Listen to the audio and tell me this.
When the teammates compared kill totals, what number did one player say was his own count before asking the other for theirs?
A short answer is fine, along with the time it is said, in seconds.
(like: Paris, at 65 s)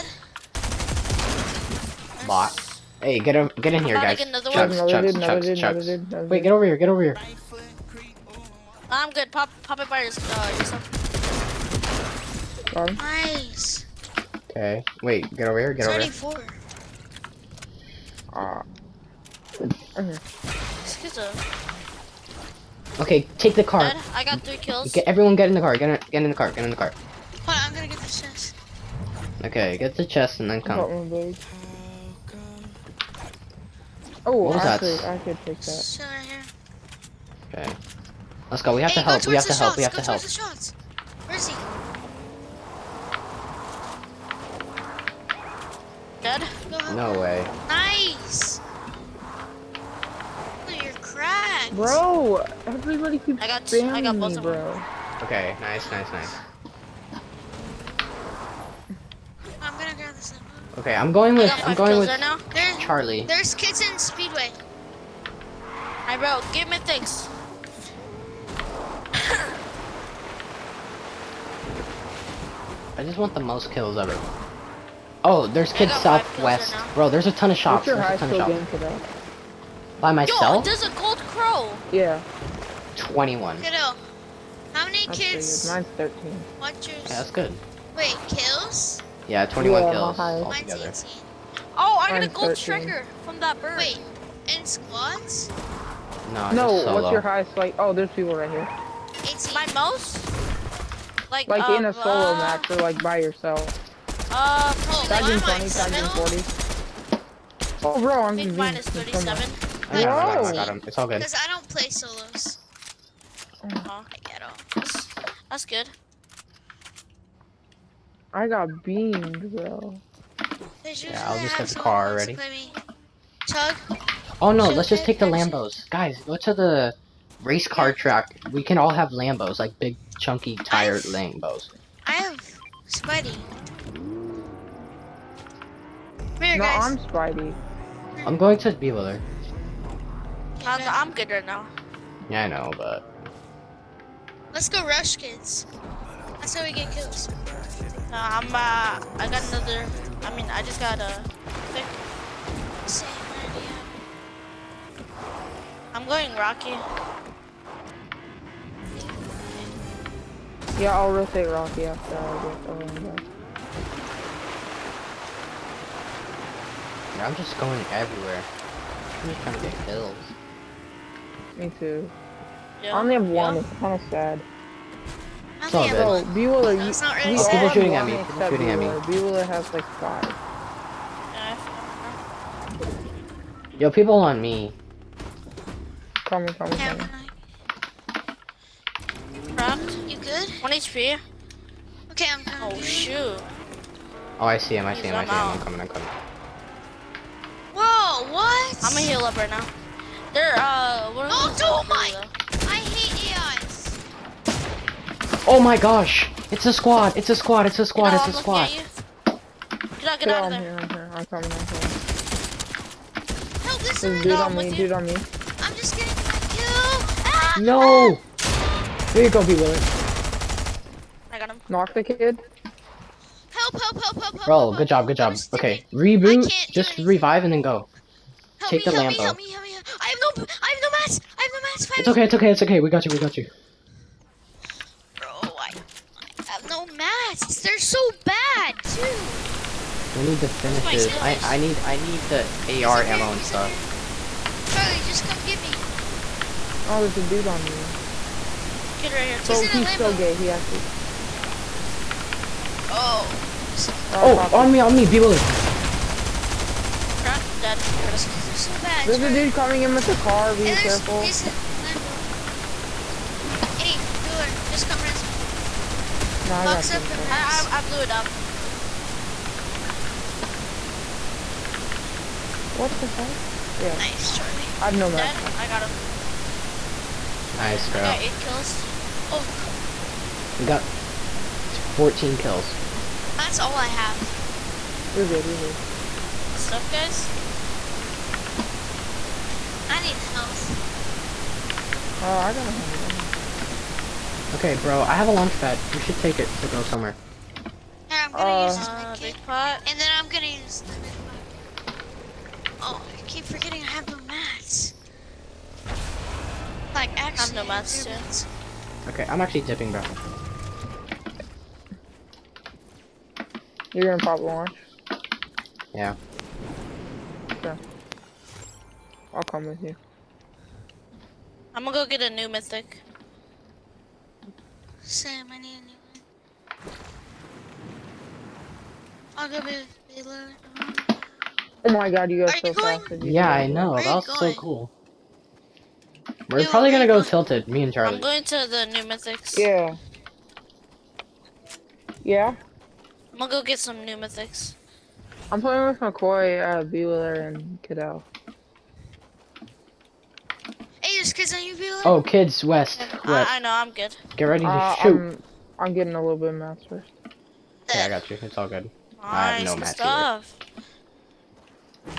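13, at 85 s.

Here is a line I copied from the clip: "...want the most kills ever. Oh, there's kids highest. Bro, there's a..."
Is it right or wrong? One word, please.
wrong.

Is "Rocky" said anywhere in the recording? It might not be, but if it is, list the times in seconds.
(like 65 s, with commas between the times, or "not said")
156 s, 161 s.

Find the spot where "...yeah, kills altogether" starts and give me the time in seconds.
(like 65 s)
89 s.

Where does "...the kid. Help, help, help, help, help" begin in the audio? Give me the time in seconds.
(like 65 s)
221 s.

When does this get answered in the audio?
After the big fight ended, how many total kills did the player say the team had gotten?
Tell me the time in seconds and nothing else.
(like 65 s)
280 s.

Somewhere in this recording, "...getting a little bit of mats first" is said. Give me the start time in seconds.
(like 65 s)
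355 s.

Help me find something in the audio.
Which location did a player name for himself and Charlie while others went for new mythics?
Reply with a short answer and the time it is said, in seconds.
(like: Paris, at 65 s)
Tilted, at 337 s.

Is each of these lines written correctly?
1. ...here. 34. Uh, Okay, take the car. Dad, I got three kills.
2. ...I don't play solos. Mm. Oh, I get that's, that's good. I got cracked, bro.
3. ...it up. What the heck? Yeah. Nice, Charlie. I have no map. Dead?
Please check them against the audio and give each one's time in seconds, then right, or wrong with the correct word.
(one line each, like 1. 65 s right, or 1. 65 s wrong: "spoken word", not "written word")
1. 16 s right
2. 111 s wrong: "beamed", not "cracked"
3. 267 s right.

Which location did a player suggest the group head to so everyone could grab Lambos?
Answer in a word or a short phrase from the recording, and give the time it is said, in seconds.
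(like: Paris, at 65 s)
race car track, at 127 s.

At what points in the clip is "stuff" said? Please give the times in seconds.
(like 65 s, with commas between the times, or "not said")
243 s, 286 s, 359 s.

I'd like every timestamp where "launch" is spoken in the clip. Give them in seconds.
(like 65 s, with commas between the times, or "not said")
295 s, 314 s.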